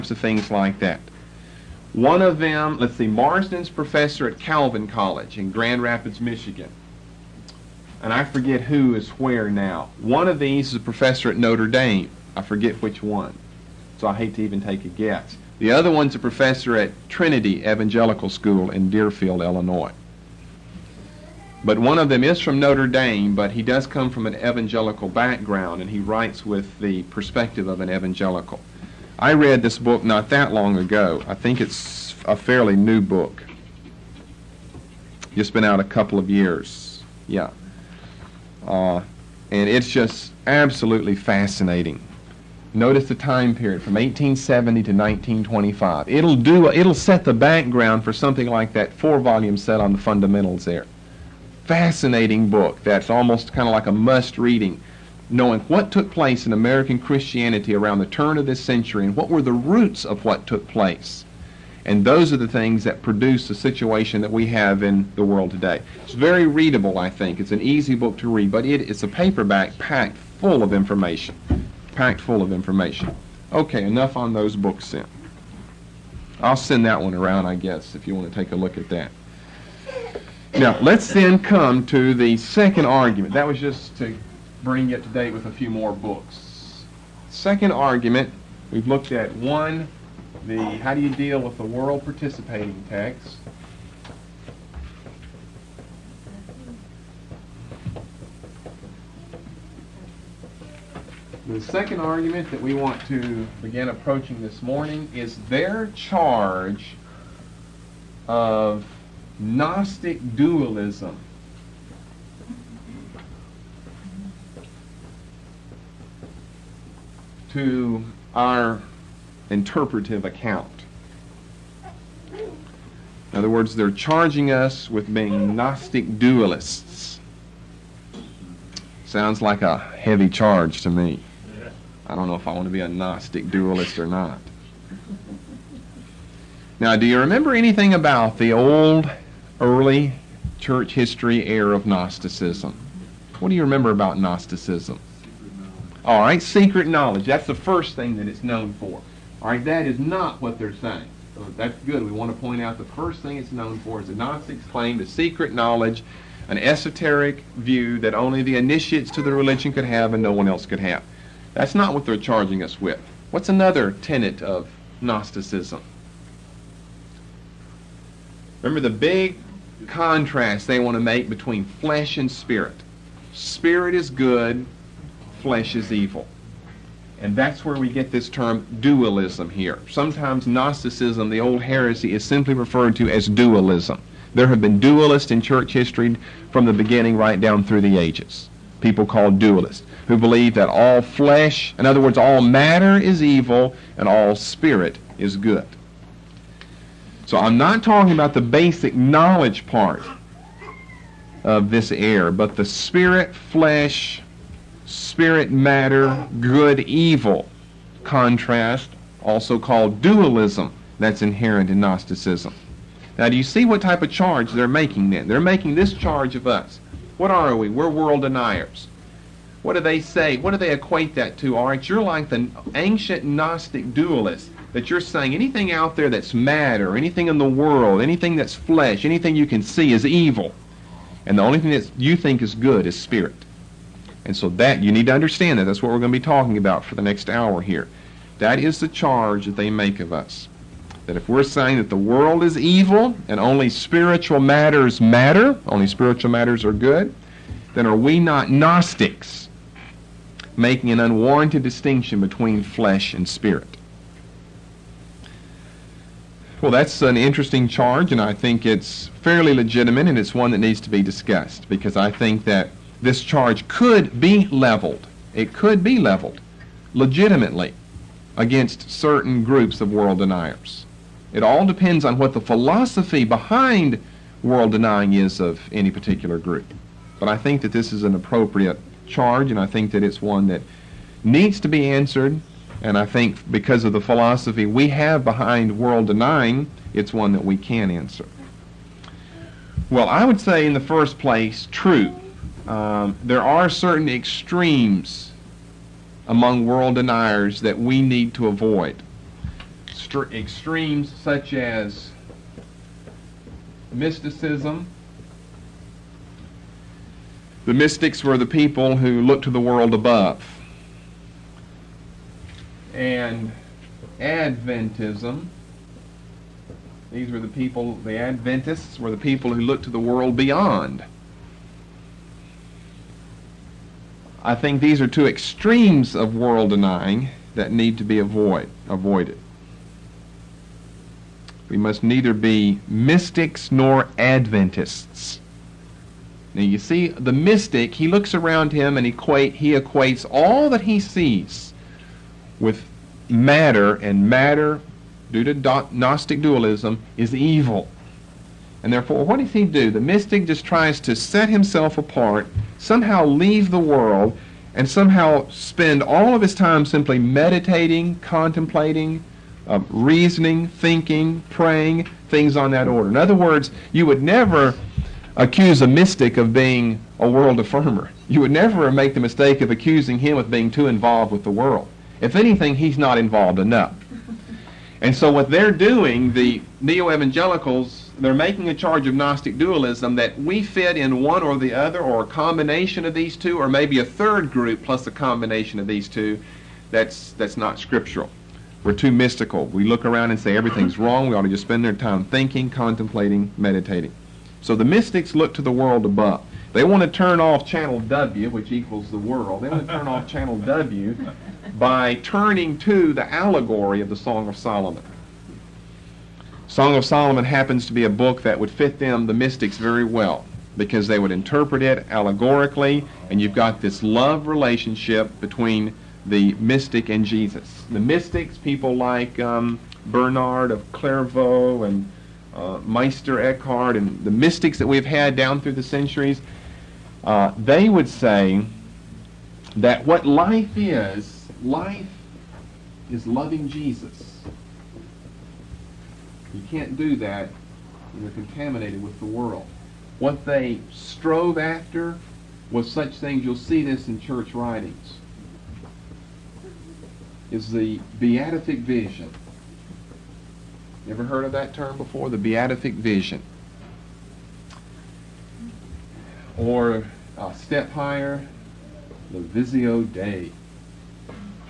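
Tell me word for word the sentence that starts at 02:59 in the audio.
Sometimes Gnosticism, the old heresy, is simply referred to as dualism.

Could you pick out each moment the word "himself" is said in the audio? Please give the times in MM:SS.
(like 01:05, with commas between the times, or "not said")
05:51.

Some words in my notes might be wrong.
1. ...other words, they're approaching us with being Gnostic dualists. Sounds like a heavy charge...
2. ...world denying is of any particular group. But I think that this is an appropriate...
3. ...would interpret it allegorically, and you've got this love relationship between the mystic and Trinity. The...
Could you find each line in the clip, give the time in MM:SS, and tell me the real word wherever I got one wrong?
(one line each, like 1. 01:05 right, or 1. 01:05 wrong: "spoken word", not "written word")
1. 02:03 wrong: "charging", not "approaching"
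2. 04:34 right
3. 06:51 wrong: "Jesus", not "Trinity".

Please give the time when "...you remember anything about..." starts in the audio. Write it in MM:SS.
02:17.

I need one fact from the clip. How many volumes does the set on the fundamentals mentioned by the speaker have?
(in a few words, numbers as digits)
4.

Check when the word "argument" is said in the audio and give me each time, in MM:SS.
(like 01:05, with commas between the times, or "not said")
01:22, 01:27, 01:41.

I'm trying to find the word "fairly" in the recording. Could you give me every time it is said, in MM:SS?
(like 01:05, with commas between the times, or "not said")
00:32, 04:19.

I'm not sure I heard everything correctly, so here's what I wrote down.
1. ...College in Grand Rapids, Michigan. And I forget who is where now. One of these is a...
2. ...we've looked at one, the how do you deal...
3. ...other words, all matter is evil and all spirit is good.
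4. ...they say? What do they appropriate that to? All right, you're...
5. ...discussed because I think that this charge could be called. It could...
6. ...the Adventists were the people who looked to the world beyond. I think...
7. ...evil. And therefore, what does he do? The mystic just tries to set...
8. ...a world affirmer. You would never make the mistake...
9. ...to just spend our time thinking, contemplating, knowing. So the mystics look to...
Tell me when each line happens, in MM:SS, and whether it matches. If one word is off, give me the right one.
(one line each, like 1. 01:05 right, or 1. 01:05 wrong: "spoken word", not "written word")
1. 00:04 right
2. 01:28 right
3. 03:11 right
4. 03:39 wrong: "equate", not "appropriate"
5. 04:21 wrong: "leveled", not "called"
6. 05:18 right
7. 05:47 right
8. 06:07 right
9. 06:31 wrong: "meditating", not "knowing".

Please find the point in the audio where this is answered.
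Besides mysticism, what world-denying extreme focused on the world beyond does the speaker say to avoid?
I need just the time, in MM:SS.
05:14.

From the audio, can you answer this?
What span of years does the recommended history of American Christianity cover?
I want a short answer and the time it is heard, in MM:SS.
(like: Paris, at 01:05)
1870 to 1925, at 00:43.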